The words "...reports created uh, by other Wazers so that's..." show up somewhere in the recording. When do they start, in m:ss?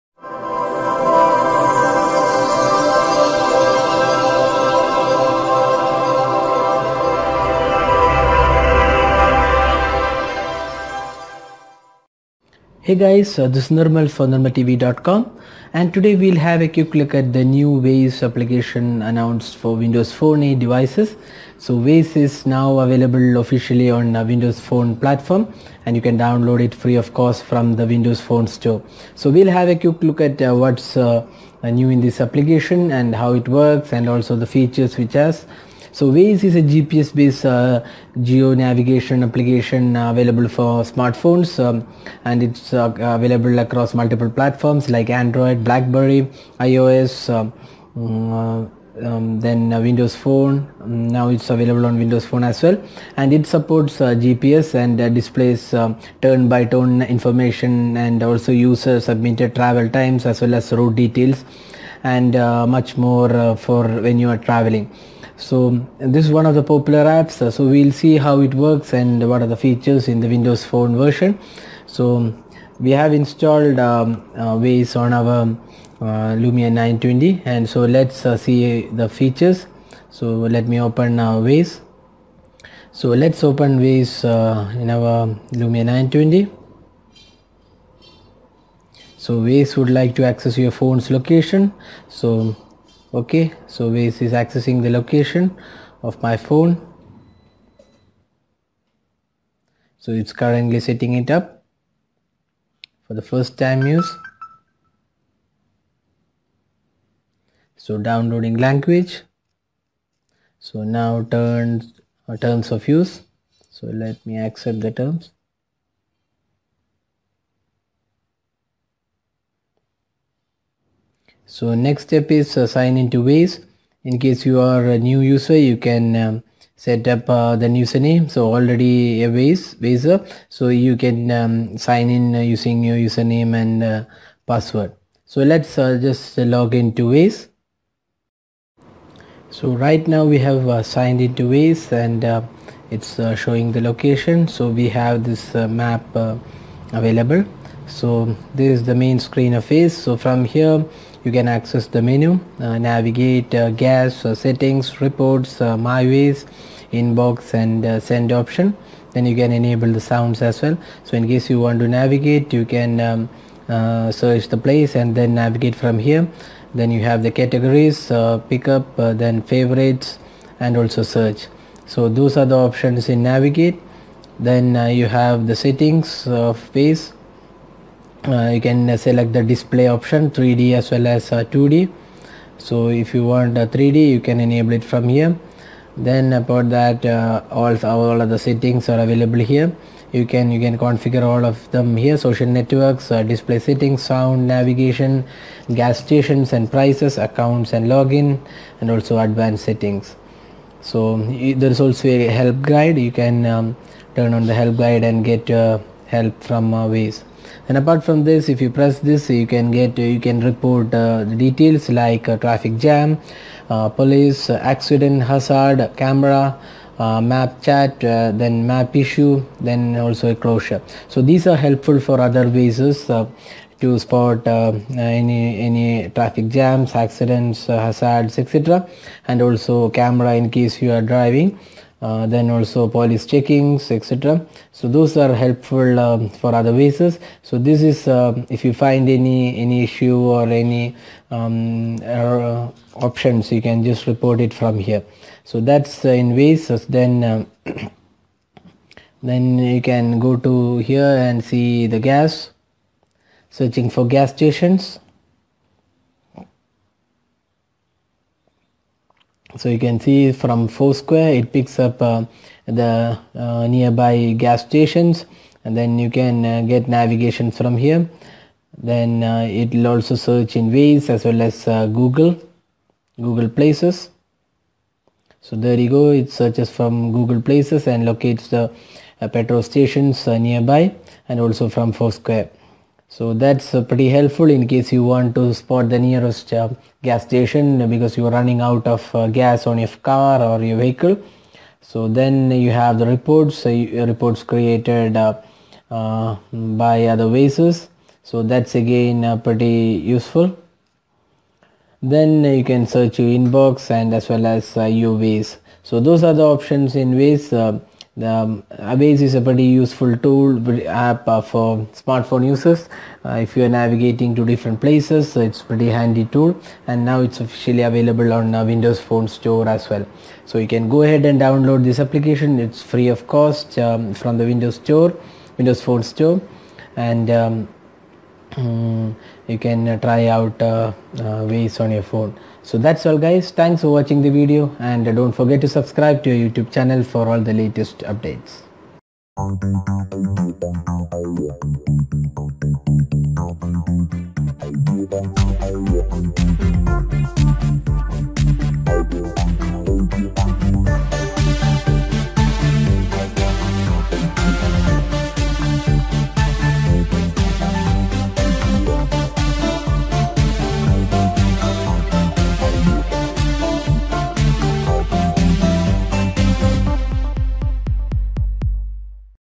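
4:54.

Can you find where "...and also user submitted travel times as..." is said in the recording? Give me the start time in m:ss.
0:57.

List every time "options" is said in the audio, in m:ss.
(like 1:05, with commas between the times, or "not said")
2:38, 2:52, 2:59, 4:03, 5:06.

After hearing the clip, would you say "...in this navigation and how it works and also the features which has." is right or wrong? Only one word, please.
wrong.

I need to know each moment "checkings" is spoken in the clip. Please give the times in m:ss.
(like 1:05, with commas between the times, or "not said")
3:53.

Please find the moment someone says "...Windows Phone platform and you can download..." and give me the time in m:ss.
0:24.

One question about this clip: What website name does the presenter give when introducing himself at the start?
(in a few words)
NirmalTV.com.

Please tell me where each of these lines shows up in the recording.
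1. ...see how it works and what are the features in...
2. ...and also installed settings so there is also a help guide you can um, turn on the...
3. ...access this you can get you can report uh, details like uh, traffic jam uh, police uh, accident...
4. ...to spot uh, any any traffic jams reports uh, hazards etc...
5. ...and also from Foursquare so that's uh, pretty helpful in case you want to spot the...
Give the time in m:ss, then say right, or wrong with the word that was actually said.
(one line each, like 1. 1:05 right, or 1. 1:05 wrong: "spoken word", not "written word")
1. 1:07 right
2. 3:18 wrong: "advanced", not "installed"
3. 3:28 wrong: "press", not "access"
4. 3:43 wrong: "accidents", not "reports"
5. 4:41 right.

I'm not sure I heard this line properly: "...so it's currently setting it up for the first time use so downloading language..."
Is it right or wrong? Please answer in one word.
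right.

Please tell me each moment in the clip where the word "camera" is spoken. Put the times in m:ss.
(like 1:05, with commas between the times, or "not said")
3:35, 3:49.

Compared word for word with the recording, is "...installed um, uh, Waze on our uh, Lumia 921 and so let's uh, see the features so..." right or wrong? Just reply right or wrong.
wrong.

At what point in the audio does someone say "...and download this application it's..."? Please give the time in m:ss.
5:21.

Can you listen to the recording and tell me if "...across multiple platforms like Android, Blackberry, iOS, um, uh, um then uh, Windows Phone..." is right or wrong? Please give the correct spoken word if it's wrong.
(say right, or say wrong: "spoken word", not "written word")
right.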